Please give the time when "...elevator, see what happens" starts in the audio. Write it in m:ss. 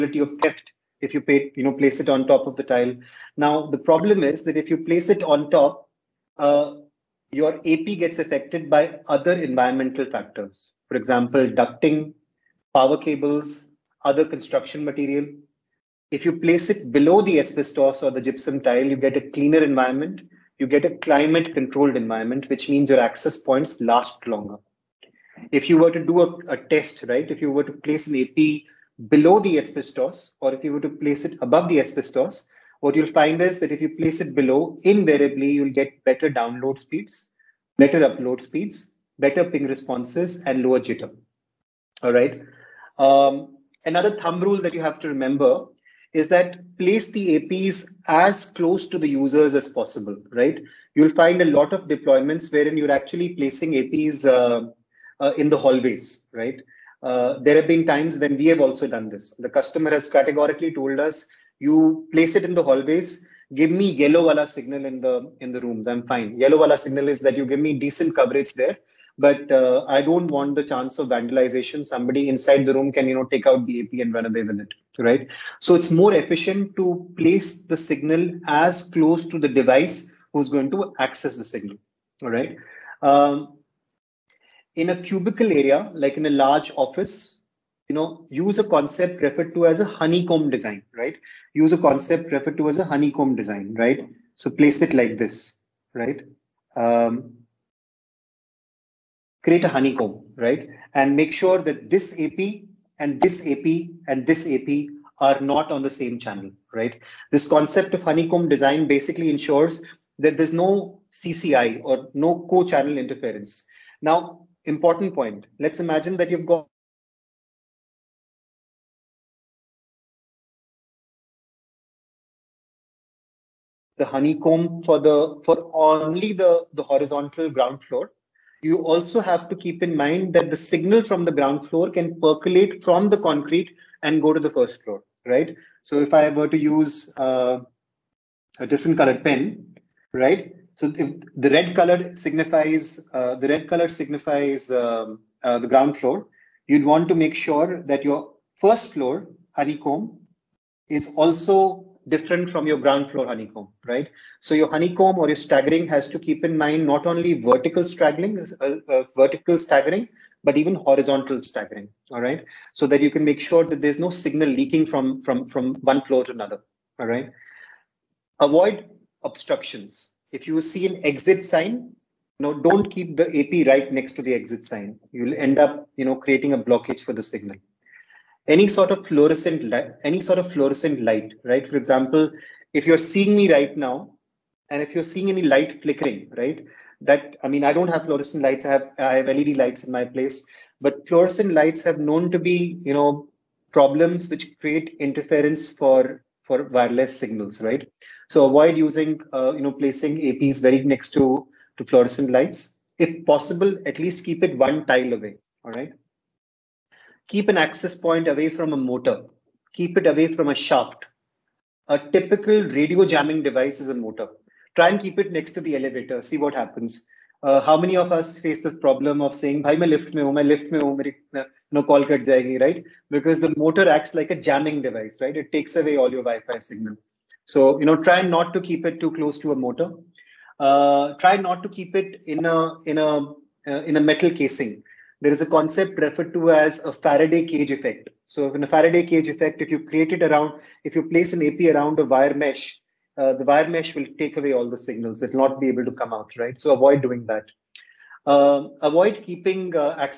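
3:35.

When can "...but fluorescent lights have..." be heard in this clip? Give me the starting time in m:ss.
3:10.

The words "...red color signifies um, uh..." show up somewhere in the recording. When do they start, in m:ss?
2:23.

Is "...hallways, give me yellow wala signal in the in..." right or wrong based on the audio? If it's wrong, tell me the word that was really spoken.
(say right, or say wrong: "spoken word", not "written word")
right.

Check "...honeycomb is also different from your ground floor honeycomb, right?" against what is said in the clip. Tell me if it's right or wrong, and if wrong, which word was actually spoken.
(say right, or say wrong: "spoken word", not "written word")
right.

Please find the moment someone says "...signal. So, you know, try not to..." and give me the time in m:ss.
3:46.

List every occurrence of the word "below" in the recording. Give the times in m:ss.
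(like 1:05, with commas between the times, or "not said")
0:16, 0:29, 0:34.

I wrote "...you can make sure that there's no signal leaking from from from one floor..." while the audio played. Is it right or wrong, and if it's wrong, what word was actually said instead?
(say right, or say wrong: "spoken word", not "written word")
right.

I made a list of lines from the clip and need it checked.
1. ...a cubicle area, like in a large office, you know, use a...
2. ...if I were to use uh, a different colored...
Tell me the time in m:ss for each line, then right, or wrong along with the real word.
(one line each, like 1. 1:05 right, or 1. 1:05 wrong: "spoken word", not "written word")
1. 1:24 right
2. 2:15 right.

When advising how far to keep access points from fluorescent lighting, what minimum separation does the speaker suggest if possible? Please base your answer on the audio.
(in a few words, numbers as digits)
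One tile away.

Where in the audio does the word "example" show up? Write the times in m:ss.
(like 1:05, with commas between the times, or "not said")
0:10, 3:01.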